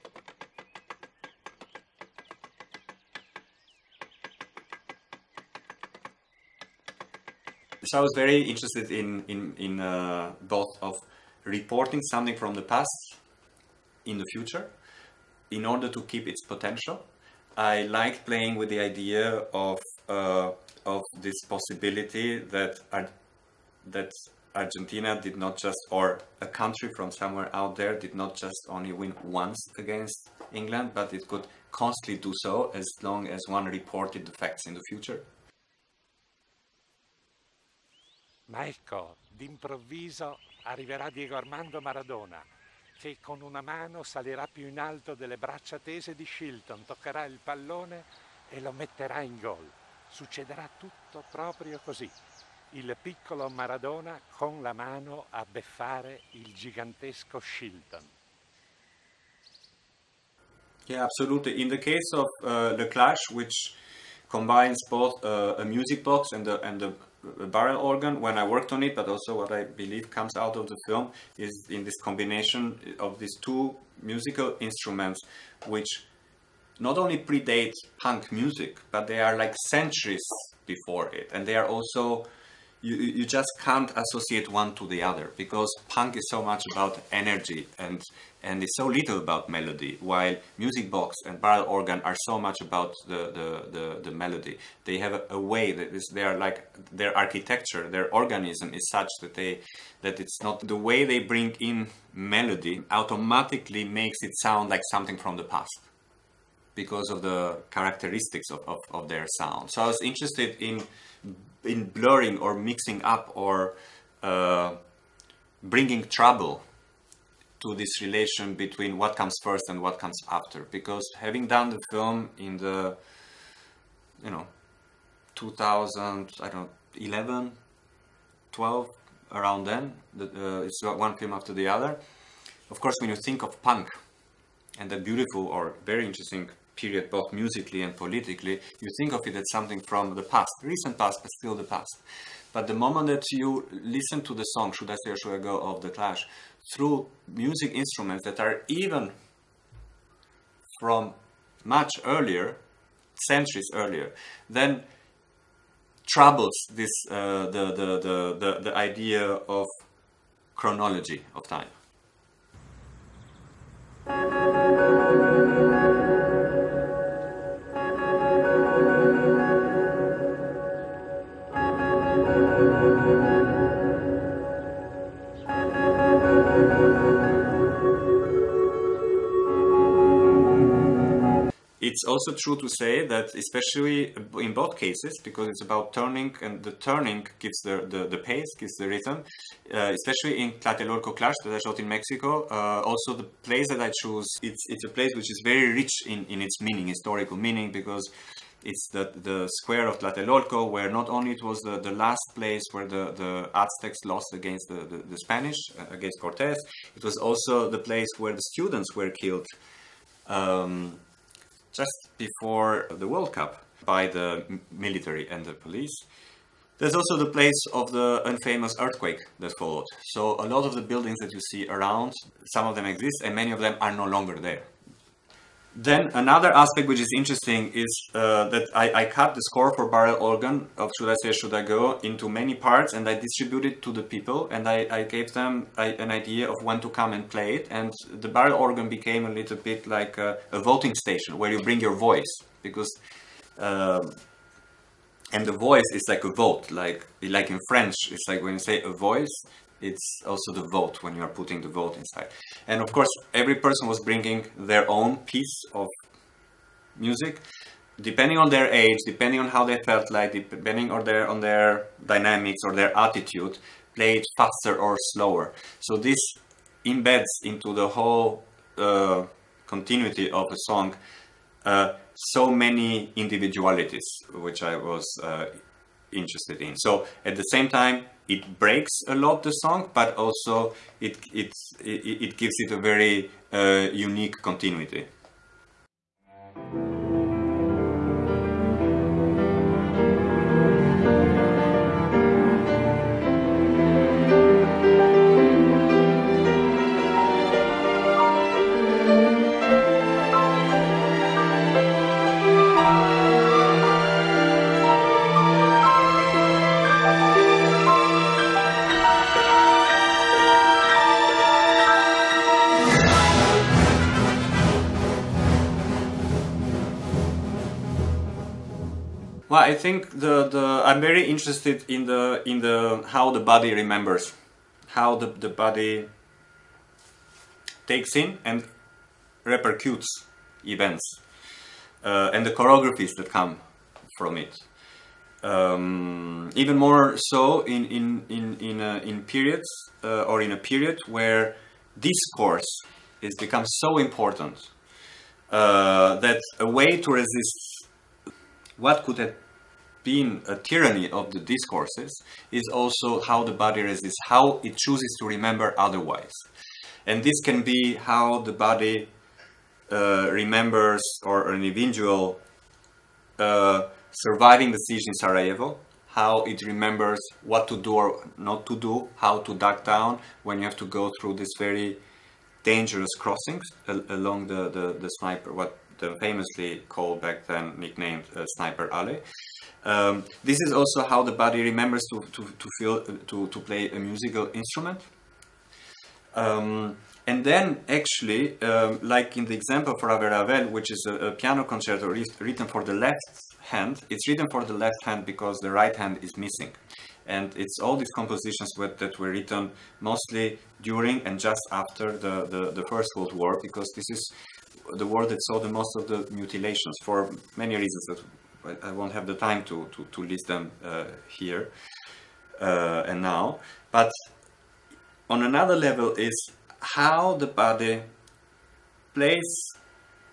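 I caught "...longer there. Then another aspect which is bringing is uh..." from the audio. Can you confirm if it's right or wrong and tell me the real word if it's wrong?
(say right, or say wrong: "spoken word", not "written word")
wrong: "interesting", not "bringing".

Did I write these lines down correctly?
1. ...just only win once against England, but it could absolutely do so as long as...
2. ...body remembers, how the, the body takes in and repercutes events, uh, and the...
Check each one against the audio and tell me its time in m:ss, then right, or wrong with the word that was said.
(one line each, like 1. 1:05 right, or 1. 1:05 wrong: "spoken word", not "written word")
1. 0:28 wrong: "constantly", not "absolutely"
2. 5:23 right.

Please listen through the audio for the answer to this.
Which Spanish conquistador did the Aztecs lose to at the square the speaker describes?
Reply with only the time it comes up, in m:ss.
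3:26.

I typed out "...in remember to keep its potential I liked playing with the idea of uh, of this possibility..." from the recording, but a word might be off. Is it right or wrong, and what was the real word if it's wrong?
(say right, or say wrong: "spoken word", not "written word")
wrong: "order", not "remember".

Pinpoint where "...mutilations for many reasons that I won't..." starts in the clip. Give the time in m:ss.
6:46.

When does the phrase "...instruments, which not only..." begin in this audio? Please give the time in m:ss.
1:14.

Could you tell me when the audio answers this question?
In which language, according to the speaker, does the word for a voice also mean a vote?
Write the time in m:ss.
4:07.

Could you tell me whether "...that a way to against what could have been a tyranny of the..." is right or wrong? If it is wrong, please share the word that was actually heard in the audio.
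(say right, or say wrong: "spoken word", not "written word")
wrong: "resist", not "against".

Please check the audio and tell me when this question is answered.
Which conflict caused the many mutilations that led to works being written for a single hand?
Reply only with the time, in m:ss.
6:42.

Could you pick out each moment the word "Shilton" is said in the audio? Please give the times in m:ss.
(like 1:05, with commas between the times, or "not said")
0:46, 0:57.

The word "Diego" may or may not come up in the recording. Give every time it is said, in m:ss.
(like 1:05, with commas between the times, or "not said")
0:41.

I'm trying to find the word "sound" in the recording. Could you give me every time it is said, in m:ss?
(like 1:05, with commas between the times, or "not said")
1:44, 1:49.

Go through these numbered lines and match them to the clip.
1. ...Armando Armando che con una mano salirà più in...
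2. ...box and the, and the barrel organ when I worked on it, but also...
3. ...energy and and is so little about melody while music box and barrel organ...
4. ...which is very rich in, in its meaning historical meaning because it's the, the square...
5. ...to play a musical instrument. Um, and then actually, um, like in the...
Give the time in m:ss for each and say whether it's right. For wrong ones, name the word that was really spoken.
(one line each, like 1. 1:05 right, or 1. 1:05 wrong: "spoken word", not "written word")
1. 0:41 wrong: "Maradona", not "Armando"
2. 1:06 right
3. 1:27 right
4. 3:15 right
5. 6:23 right.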